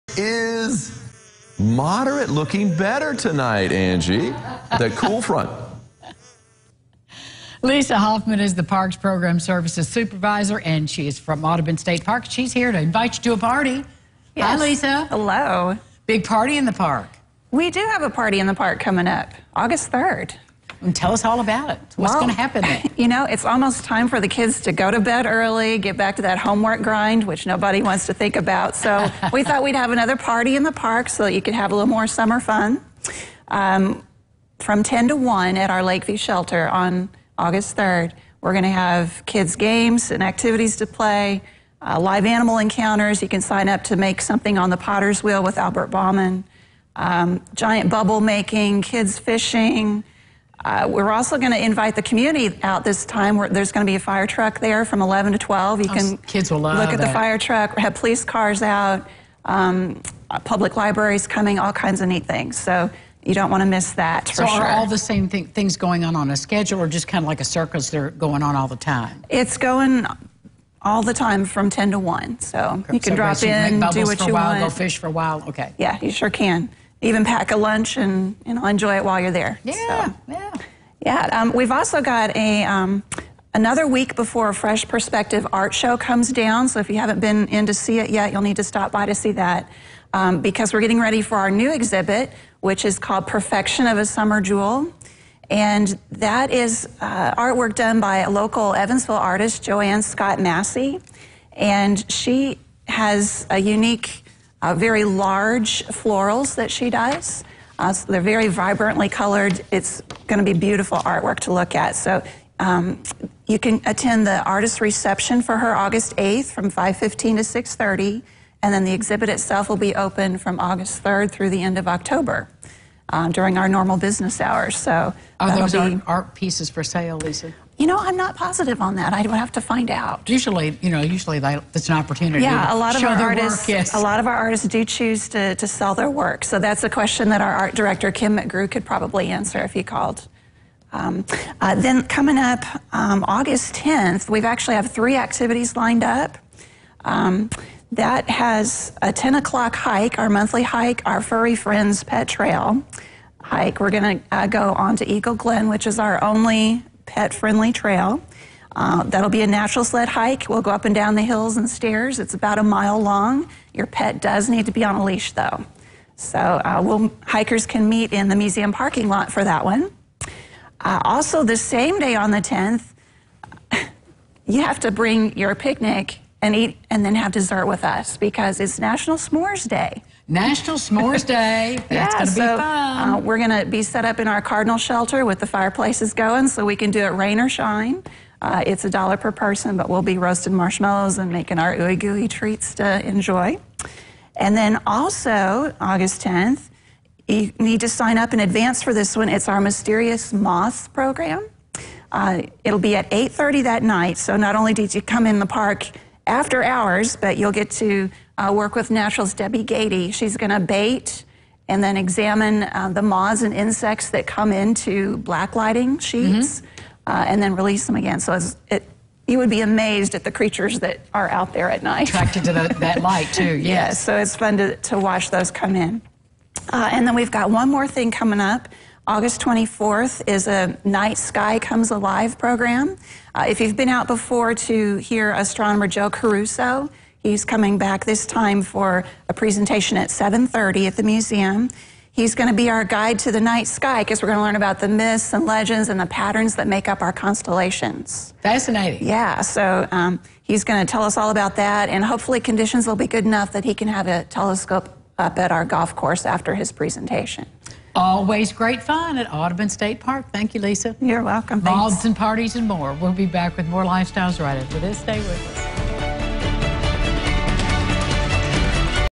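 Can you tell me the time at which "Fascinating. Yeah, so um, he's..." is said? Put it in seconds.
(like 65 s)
248 s.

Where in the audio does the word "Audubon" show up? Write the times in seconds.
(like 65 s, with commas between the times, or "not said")
11 s, 259 s.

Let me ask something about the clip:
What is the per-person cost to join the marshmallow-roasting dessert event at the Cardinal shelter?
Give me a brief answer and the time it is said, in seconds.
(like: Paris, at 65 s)
$1, at 188 s.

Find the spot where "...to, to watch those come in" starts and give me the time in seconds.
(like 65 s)
224 s.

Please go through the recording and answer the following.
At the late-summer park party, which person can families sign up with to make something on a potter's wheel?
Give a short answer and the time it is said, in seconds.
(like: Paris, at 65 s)
Albert Bauman, at 45 s.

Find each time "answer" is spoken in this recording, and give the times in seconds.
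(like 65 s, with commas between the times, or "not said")
139 s.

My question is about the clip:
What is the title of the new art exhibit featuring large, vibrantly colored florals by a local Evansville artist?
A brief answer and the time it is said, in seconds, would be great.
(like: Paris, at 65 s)
Perfection of a Summer Jewel, at 93 s.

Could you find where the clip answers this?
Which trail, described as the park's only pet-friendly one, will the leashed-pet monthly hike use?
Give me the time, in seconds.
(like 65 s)
155 s.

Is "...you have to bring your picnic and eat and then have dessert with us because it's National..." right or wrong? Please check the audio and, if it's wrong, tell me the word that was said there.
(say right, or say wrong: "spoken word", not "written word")
right.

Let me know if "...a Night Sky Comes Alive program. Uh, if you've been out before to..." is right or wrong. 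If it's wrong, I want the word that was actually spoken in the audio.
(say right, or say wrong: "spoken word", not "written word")
right.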